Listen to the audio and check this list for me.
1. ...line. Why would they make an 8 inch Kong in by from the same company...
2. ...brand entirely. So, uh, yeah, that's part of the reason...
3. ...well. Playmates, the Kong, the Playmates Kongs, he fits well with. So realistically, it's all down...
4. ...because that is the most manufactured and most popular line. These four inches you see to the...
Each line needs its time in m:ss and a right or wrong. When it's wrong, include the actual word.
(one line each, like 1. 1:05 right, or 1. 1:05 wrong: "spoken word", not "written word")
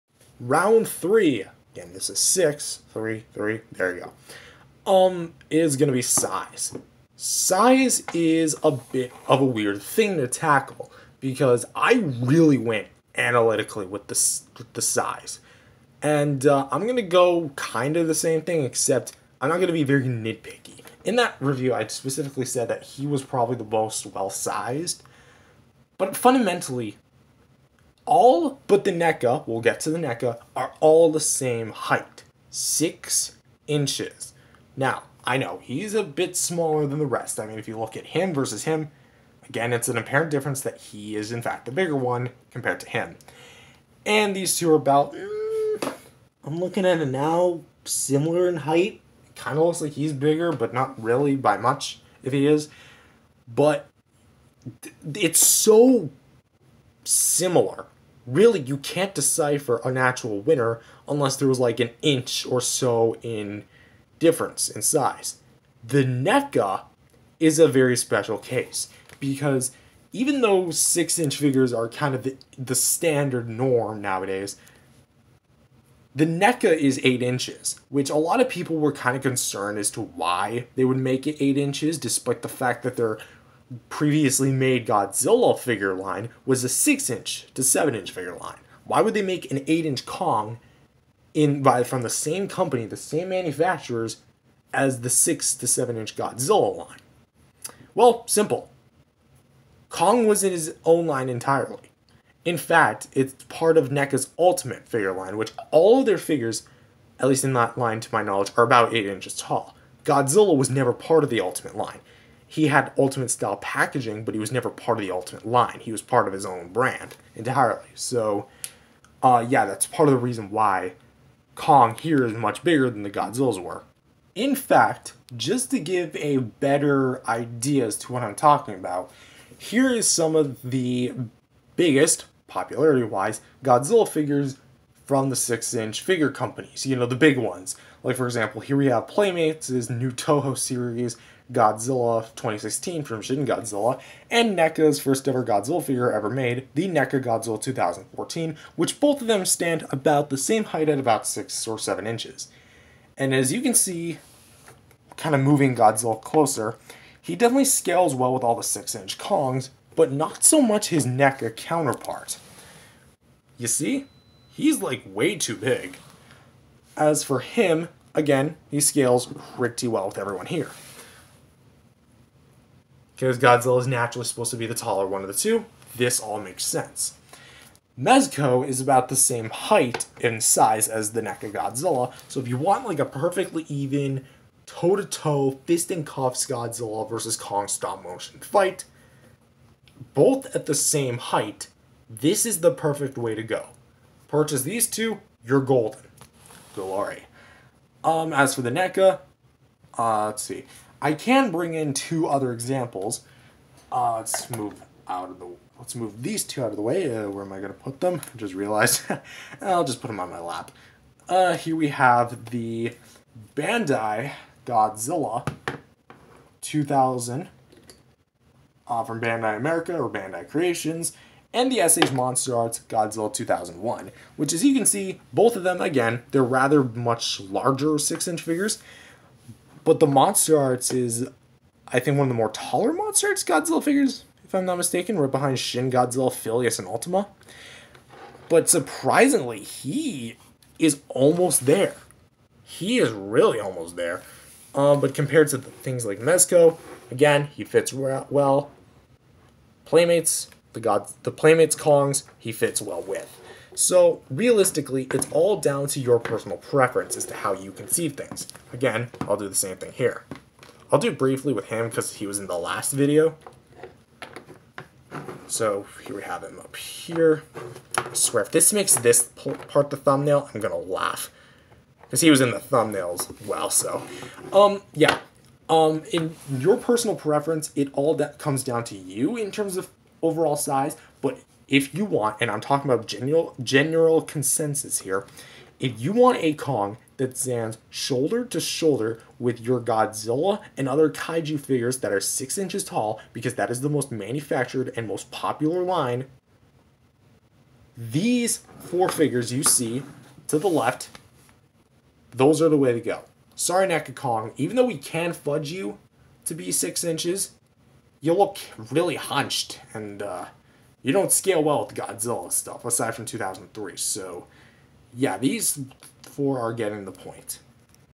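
1. 1:28 right
2. 1:56 right
3. 4:07 wrong: "God", not "Kong"
4. 4:53 wrong: "figures", not "inches".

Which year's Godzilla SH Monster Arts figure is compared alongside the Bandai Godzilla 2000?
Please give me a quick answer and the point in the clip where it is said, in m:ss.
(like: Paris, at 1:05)
2001, at 3:43.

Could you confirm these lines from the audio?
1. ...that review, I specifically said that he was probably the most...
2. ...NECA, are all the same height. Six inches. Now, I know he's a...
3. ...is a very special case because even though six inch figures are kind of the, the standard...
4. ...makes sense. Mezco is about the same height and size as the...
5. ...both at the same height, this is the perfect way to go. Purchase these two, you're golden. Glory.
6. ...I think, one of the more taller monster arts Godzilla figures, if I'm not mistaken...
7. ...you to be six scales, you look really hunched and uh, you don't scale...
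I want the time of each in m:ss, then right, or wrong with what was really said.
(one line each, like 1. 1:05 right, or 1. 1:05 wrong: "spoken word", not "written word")
1. 0:21 right
2. 0:29 right
3. 1:07 right
4. 2:56 right
5. 3:10 right
6. 3:51 right
7. 5:05 wrong: "inches", not "scales".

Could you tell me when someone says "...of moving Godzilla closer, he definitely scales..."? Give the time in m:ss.
2:35.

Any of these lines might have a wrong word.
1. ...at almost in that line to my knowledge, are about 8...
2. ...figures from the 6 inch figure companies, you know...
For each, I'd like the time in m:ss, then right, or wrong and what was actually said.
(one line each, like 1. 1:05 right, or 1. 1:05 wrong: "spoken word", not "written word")
1. 1:47 wrong: "least", not "almost"
2. 2:14 right.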